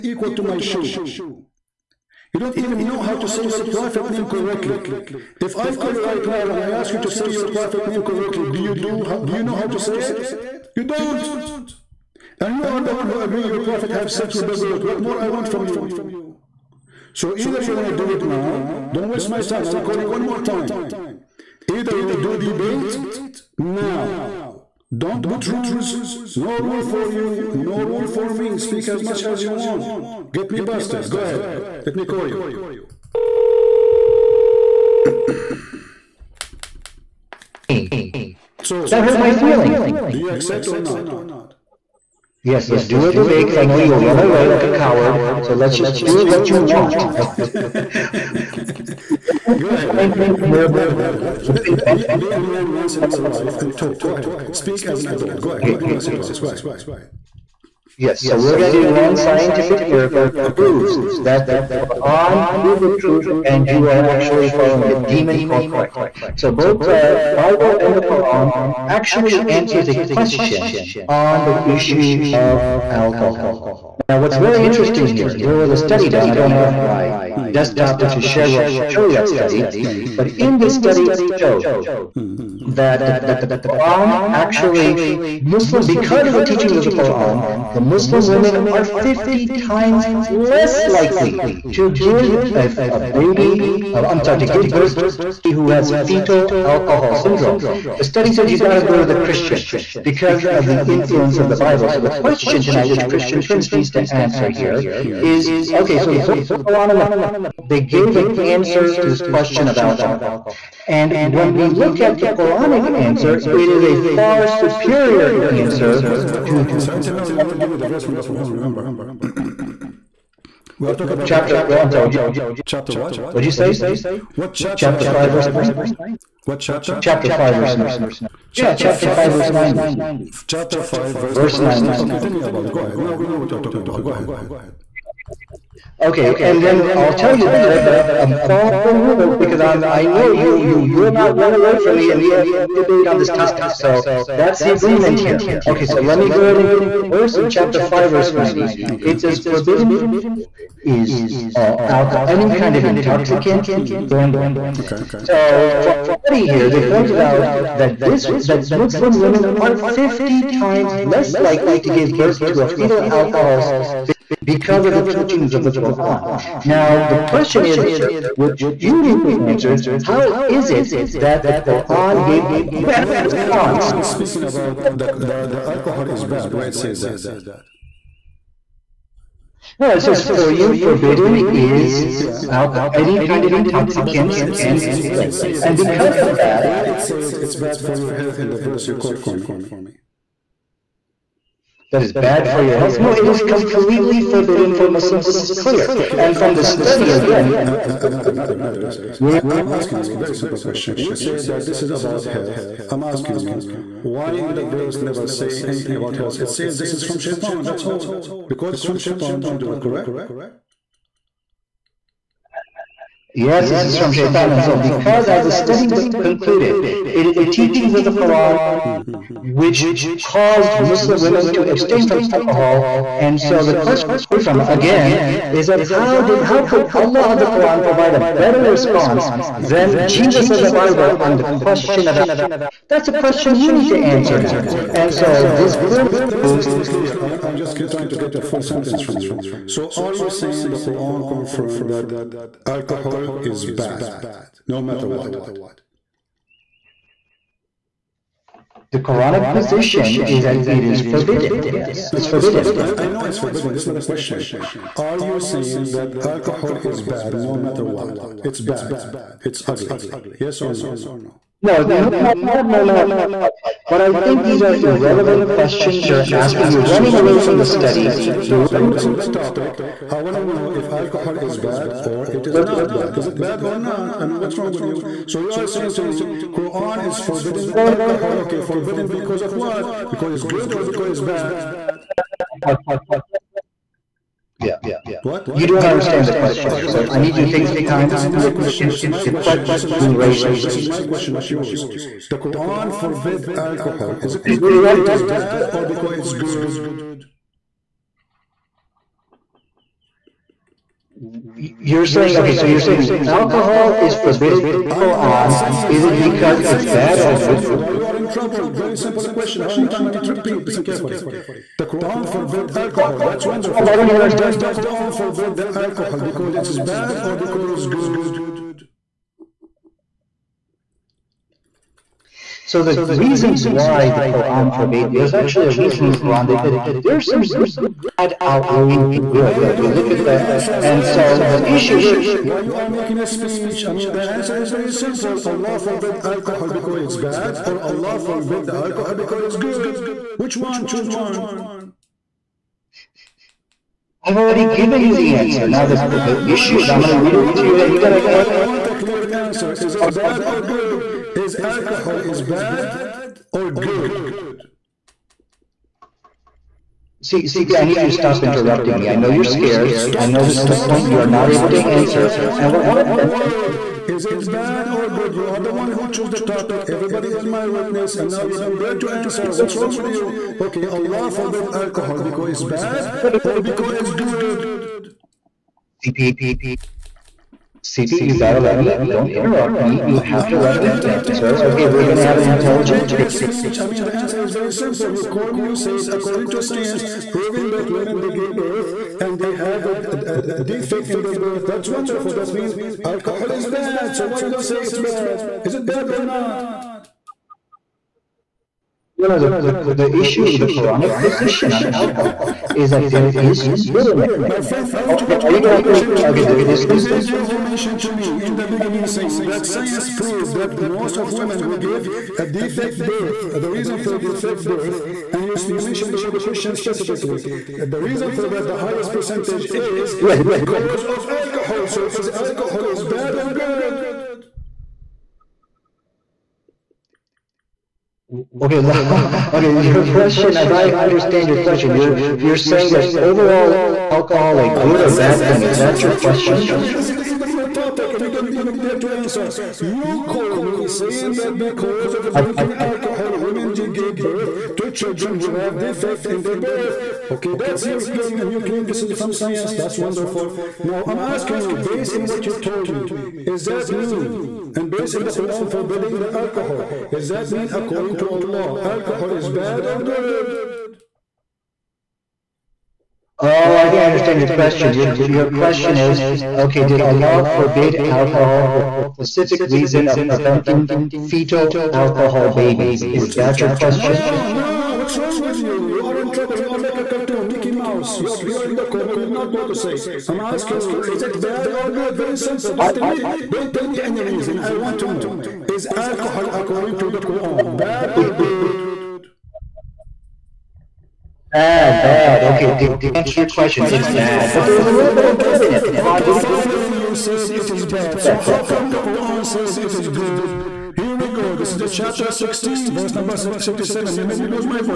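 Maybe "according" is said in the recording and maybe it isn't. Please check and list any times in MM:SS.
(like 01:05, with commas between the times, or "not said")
06:26, 07:37, 08:06.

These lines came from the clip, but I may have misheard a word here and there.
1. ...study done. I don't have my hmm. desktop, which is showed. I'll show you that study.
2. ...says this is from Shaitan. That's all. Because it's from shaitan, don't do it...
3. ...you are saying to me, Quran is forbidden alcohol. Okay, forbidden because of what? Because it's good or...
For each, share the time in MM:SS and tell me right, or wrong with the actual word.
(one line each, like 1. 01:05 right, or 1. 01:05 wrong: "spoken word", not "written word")
1. 01:15 wrong: "shared", not "showed"
2. 03:26 right
3. 04:35 right.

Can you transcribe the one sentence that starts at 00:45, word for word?
So let's just do so, what you want.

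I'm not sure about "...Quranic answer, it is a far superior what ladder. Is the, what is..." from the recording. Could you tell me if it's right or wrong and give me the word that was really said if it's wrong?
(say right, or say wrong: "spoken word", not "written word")
wrong: "answer", not "ladder".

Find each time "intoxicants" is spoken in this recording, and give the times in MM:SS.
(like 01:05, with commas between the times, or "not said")
02:32, 03:03.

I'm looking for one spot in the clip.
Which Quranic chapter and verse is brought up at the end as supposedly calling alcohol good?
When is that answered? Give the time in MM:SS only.
08:21.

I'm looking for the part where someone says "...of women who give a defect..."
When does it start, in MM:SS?
06:51.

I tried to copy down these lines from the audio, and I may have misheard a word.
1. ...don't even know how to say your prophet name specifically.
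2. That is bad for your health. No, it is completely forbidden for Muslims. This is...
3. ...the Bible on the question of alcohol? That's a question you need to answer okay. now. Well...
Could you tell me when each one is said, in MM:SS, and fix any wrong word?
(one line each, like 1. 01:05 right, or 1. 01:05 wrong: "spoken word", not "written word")
1. 00:02 wrong: "correctly", not "specifically"
2. 03:11 right
3. 03:50 right.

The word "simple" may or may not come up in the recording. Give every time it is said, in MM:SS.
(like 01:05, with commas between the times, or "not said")
03:20, 05:08, 05:34, 06:24, 08:02.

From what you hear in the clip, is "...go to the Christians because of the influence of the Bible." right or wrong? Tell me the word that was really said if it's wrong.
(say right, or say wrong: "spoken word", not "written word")
right.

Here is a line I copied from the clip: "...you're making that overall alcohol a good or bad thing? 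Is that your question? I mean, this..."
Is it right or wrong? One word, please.
wrong.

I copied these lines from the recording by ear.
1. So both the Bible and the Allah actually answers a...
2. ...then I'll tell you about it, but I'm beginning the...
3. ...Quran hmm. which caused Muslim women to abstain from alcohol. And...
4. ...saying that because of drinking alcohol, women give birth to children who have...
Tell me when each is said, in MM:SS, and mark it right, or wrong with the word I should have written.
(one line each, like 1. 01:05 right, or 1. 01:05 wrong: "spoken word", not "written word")
1. 01:06 wrong: "Quran", not "Allah"
2. 02:16 wrong: "following", not "beginning"
3. 03:38 right
4. 07:20 right.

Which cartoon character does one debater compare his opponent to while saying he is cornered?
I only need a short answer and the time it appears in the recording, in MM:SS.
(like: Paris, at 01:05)
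Mickey Mouse, at 07:57.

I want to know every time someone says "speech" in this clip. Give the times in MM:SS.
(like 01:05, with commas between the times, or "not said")
05:33, 06:23.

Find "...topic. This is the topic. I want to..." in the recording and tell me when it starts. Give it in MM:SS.
04:28.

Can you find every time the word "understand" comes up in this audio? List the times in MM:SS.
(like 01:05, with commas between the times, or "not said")
04:45, 07:10, 07:44.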